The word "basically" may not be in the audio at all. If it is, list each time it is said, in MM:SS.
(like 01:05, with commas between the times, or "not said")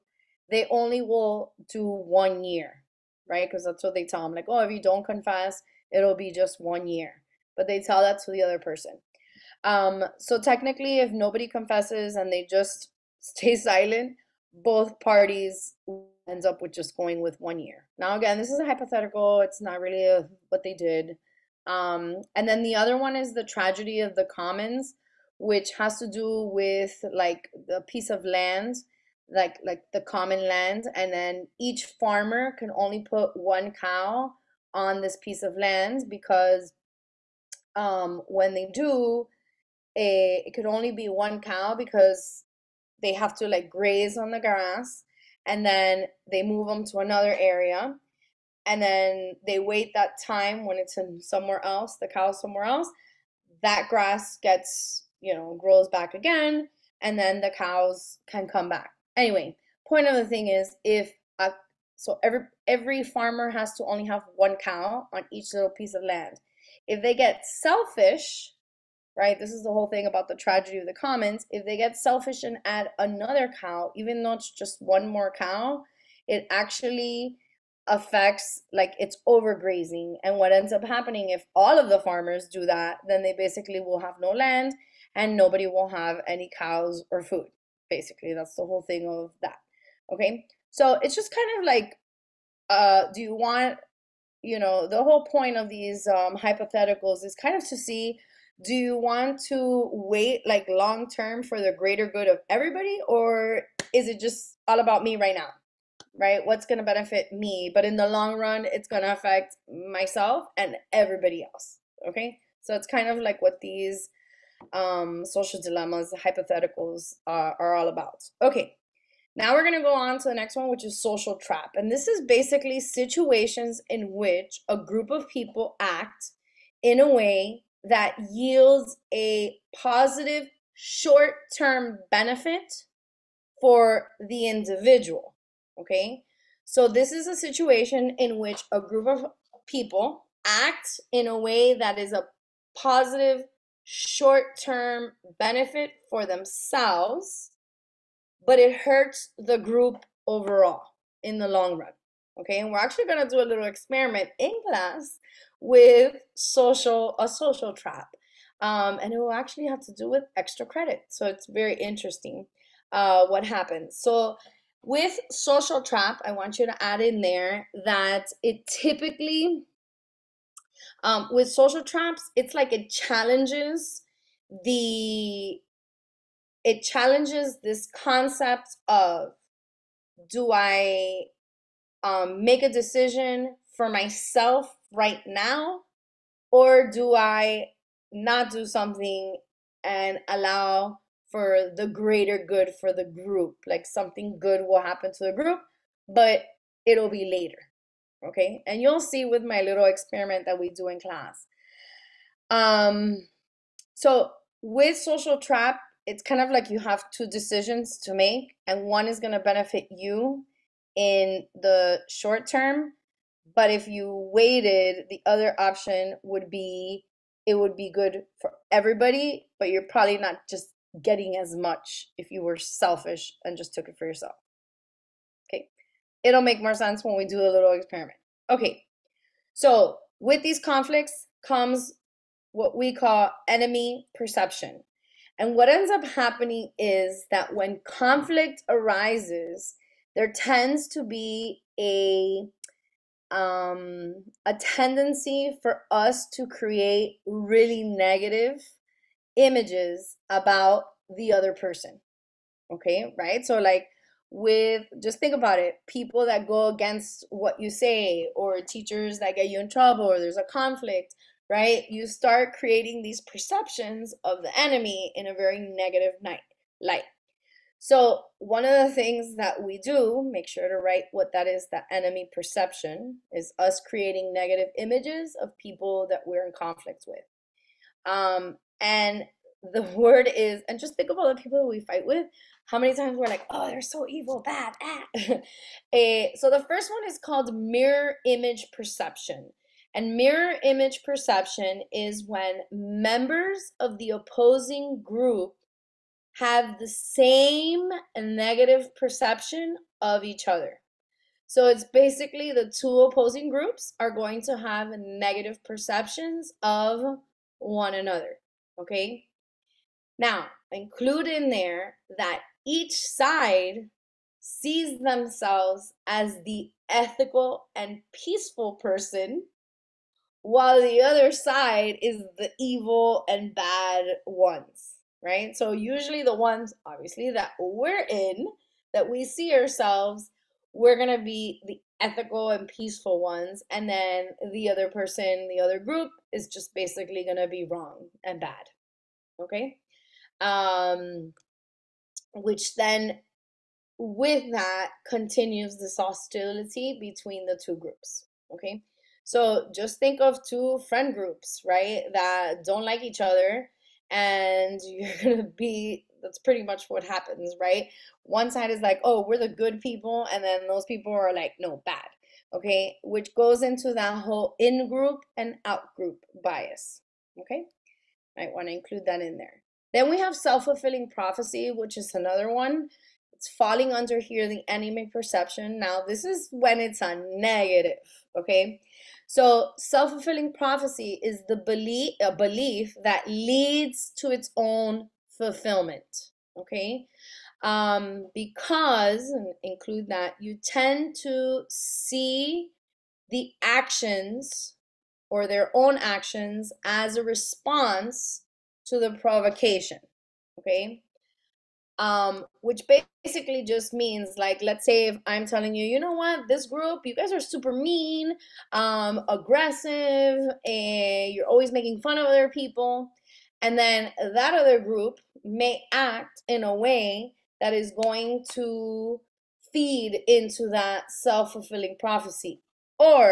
01:23, 01:27, 02:02, 05:01, 05:36, 06:43.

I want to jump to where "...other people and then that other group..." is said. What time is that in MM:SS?
06:52.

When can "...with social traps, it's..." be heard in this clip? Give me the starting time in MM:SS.
02:51.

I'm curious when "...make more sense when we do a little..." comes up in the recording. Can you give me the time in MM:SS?
03:46.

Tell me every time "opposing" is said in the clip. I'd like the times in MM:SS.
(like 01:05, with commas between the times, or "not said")
04:54, 05:03.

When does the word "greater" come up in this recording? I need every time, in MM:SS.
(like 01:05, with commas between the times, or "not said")
01:41, 03:11.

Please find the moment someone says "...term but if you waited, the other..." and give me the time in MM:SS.
03:32.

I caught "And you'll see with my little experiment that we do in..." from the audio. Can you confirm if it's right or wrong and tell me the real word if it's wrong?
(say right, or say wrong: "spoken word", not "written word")
right.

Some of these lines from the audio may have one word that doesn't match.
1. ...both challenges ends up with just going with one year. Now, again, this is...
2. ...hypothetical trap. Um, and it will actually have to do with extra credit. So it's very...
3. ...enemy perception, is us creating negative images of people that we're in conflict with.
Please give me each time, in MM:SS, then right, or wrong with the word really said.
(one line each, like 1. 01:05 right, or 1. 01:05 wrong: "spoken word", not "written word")
1. 00:14 wrong: "parties", not "challenges"
2. 02:37 wrong: "social", not "hypothetical"
3. 04:31 right.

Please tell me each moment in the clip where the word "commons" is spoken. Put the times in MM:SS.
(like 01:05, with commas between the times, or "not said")
00:24, 00:30, 01:10.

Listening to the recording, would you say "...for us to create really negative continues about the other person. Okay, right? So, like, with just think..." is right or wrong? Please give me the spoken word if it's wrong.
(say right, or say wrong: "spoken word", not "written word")
wrong: "images", not "continues".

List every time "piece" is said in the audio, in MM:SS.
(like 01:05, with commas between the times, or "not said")
00:27, 00:35, 01:05.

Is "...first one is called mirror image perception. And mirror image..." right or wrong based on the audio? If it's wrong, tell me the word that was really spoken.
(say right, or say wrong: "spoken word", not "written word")
right.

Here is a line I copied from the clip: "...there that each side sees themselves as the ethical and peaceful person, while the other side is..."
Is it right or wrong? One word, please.
right.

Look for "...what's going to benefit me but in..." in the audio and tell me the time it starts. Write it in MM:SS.
01:46.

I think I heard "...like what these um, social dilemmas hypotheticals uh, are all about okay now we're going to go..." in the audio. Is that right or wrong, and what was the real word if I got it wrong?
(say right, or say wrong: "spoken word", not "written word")
right.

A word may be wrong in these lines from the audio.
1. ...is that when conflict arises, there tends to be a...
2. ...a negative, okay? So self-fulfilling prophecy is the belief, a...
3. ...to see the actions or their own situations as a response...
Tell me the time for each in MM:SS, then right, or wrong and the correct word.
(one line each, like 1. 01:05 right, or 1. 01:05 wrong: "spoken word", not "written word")
1. 03:56 right
2. 06:17 right
3. 06:31 wrong: "actions", not "situations".